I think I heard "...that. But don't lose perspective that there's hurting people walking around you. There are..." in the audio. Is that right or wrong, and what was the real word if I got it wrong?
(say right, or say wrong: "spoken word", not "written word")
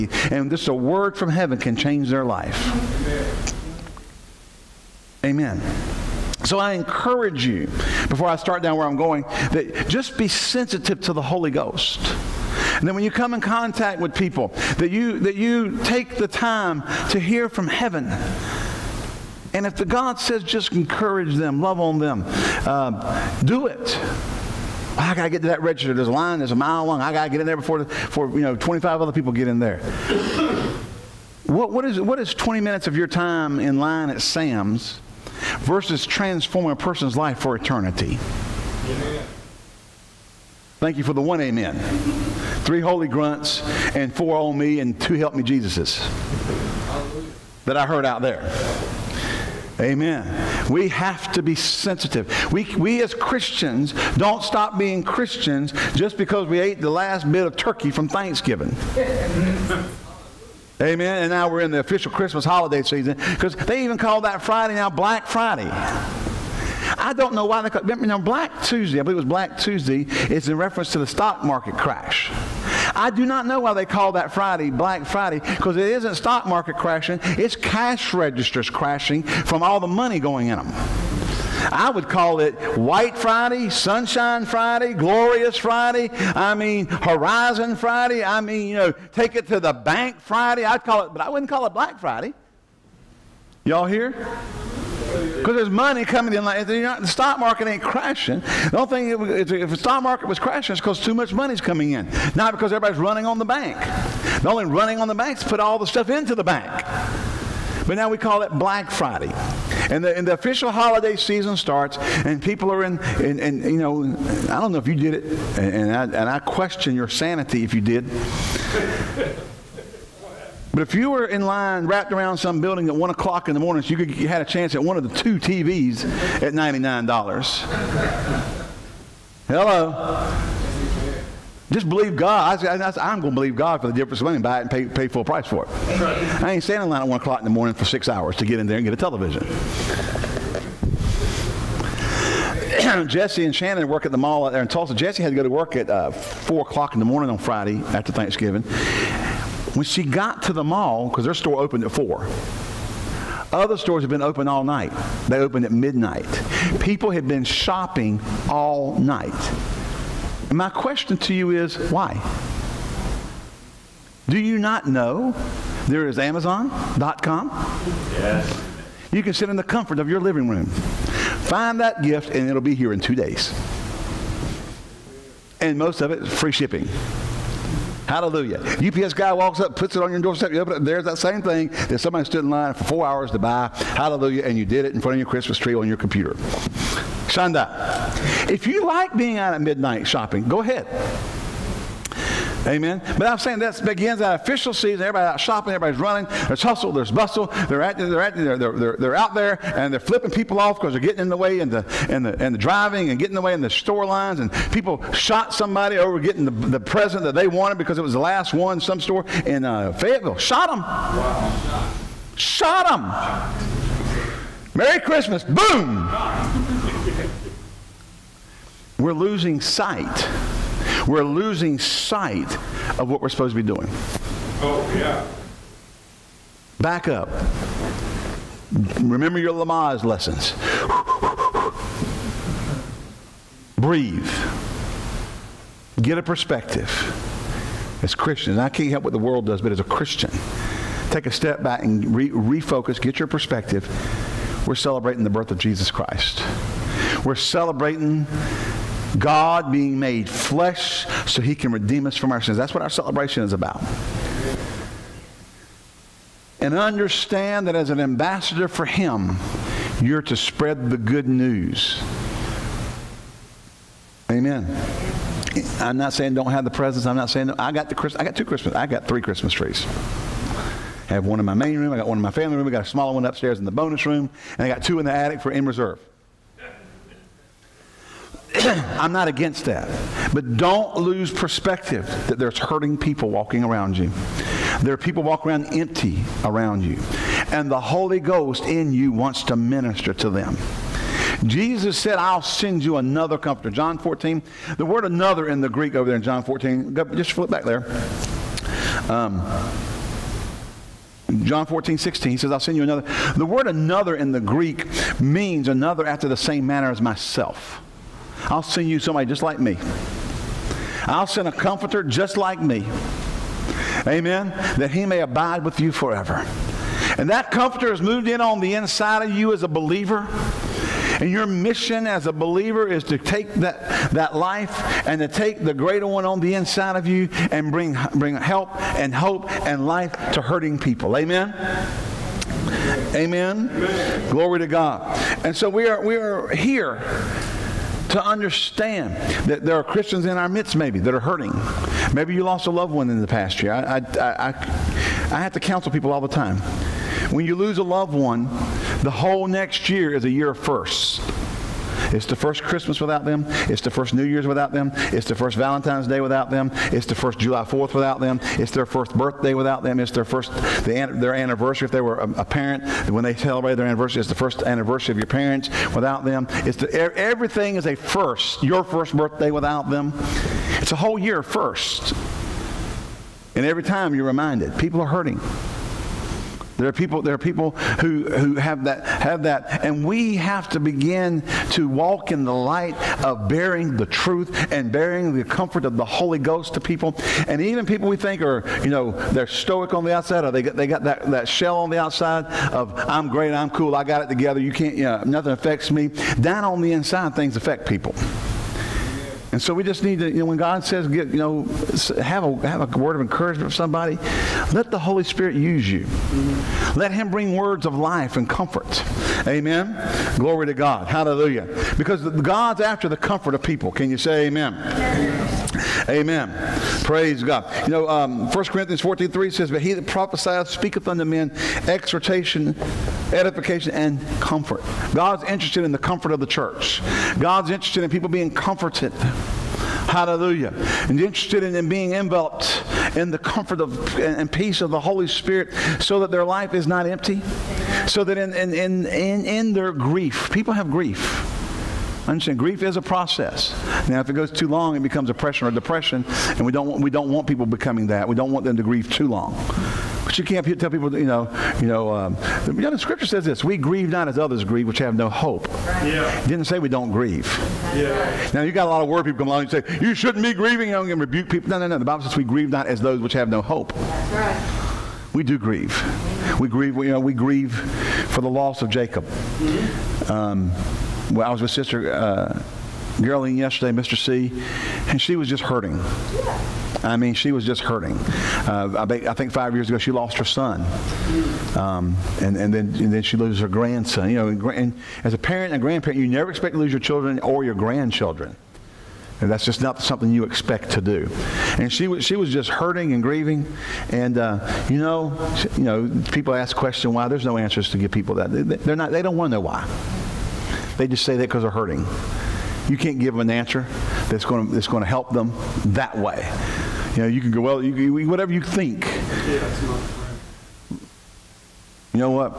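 right.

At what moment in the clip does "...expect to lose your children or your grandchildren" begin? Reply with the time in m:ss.
8:06.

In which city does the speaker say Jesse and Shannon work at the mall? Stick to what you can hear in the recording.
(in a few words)
Tulsa.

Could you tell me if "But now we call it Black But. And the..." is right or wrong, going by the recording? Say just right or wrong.
wrong.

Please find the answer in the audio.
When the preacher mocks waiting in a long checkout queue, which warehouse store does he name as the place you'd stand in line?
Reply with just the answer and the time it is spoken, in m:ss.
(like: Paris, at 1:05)
Sam's, at 0:34.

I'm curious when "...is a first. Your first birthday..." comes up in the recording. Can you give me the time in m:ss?
6:07.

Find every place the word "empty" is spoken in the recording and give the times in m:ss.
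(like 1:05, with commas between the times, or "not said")
4:45, 7:17.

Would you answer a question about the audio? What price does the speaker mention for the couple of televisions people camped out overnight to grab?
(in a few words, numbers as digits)
$99.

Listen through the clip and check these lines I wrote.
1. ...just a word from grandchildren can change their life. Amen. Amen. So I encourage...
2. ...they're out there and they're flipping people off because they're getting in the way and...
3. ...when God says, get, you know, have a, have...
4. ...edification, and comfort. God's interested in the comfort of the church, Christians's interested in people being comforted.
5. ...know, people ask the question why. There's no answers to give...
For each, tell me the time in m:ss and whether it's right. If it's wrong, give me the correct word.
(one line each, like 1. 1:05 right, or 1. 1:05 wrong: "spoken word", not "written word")
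1. 0:00 wrong: "heaven", not "grandchildren"
2. 3:18 right
3. 6:40 right
4. 7:03 wrong: "God", not "Christians"
5. 8:15 right.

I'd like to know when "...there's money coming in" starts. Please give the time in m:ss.
1:35.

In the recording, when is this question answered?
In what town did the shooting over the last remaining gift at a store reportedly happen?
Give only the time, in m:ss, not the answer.
3:29.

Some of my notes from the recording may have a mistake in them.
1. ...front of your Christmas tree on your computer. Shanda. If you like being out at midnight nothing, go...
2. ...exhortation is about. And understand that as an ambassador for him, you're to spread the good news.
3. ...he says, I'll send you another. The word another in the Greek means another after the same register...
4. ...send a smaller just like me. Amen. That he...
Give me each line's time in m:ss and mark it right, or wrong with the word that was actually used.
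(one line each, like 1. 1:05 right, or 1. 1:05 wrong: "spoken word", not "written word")
1. 3:05 wrong: "shopping", not "nothing"
2. 4:12 wrong: "celebration", not "exhortation"
3. 5:02 wrong: "manner", not "register"
4. 5:11 wrong: "comforter", not "smaller".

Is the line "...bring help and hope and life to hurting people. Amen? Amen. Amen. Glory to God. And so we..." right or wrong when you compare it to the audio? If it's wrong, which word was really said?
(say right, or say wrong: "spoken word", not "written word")
right.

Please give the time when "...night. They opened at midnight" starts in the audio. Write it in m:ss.
2:34.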